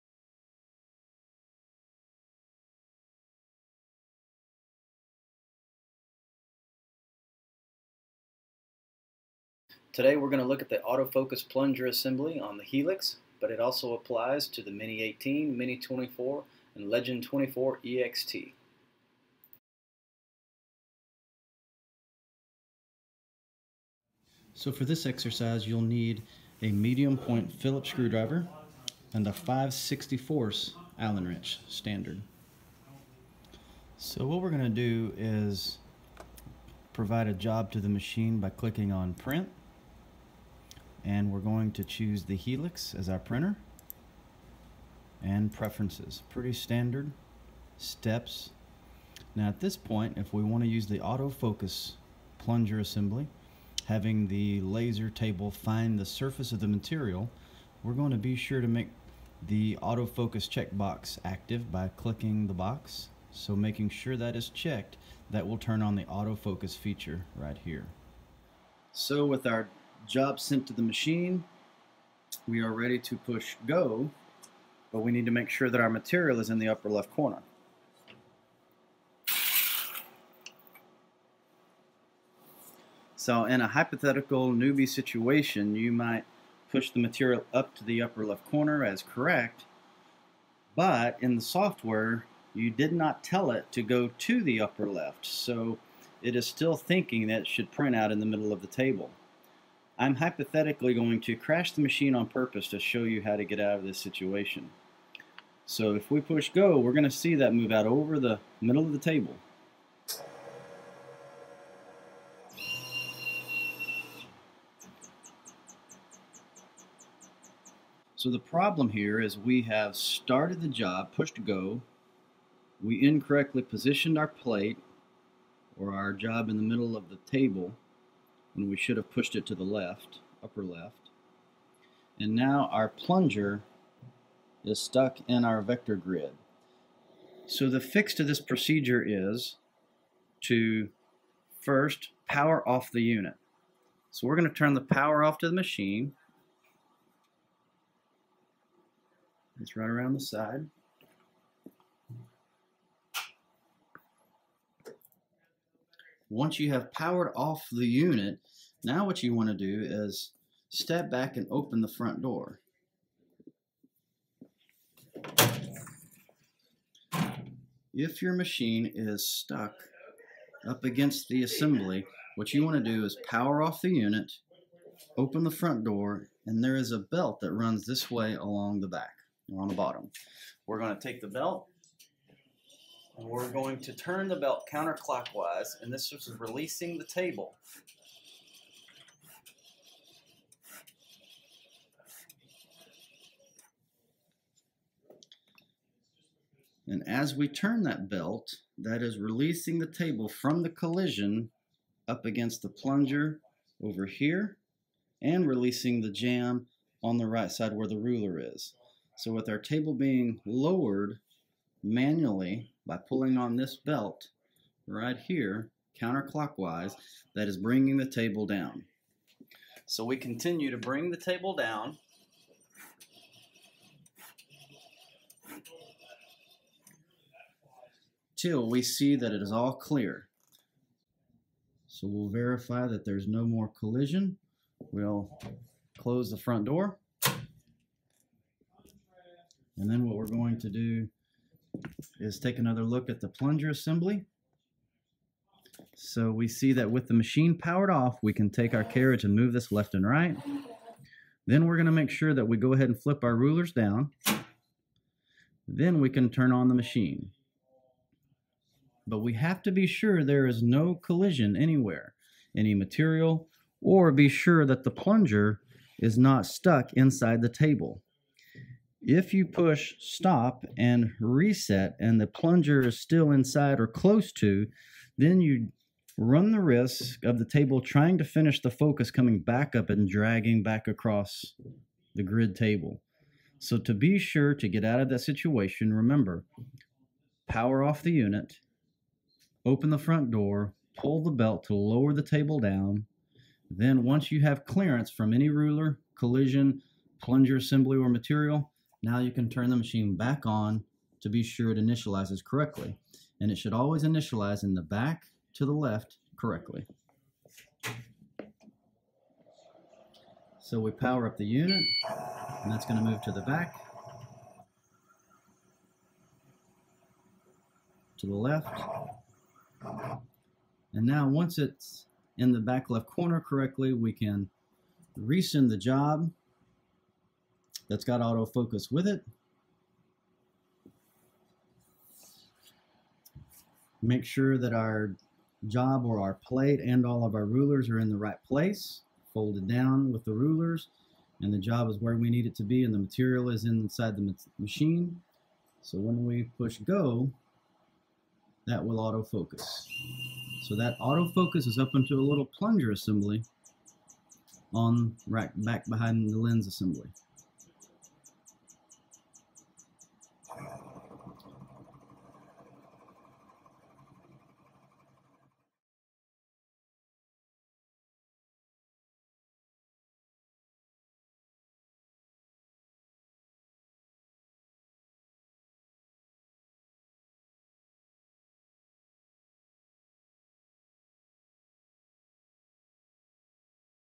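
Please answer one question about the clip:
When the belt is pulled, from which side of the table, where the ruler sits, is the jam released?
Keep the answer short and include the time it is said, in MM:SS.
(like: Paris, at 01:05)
right side, at 03:27.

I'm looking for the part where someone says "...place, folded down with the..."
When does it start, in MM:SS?
05:38.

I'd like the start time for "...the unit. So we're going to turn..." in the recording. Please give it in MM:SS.
02:22.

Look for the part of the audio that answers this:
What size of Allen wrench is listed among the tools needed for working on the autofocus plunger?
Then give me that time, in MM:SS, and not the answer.
00:29.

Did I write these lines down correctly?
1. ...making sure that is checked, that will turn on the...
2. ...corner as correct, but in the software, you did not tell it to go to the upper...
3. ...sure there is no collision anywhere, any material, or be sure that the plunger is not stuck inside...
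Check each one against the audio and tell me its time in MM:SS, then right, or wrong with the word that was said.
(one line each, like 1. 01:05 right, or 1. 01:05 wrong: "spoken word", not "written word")
1. 01:03 right
2. 01:28 right
3. 04:19 right.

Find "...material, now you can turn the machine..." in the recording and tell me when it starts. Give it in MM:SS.
04:58.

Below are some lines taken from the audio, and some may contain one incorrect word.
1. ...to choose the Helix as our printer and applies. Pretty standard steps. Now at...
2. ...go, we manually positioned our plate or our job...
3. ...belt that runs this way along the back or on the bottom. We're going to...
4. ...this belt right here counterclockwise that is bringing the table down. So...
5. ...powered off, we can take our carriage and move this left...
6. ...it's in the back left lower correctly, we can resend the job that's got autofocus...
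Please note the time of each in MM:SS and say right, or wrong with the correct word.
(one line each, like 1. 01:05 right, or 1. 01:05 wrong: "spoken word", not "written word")
1. 00:41 wrong: "preferences", not "applies"
2. 02:01 wrong: "incorrectly", not "manually"
3. 02:56 right
4. 03:33 right
5. 04:07 right
6. 05:21 wrong: "corner", not "lower".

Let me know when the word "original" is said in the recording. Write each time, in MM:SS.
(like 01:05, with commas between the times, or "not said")
not said.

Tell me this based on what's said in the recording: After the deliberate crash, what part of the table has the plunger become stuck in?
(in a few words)
vector grid.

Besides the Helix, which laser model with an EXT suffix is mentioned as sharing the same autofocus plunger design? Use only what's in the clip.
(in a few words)
Legend 24 EXT.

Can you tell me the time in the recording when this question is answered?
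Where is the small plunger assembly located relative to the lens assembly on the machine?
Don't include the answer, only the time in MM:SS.
05:55.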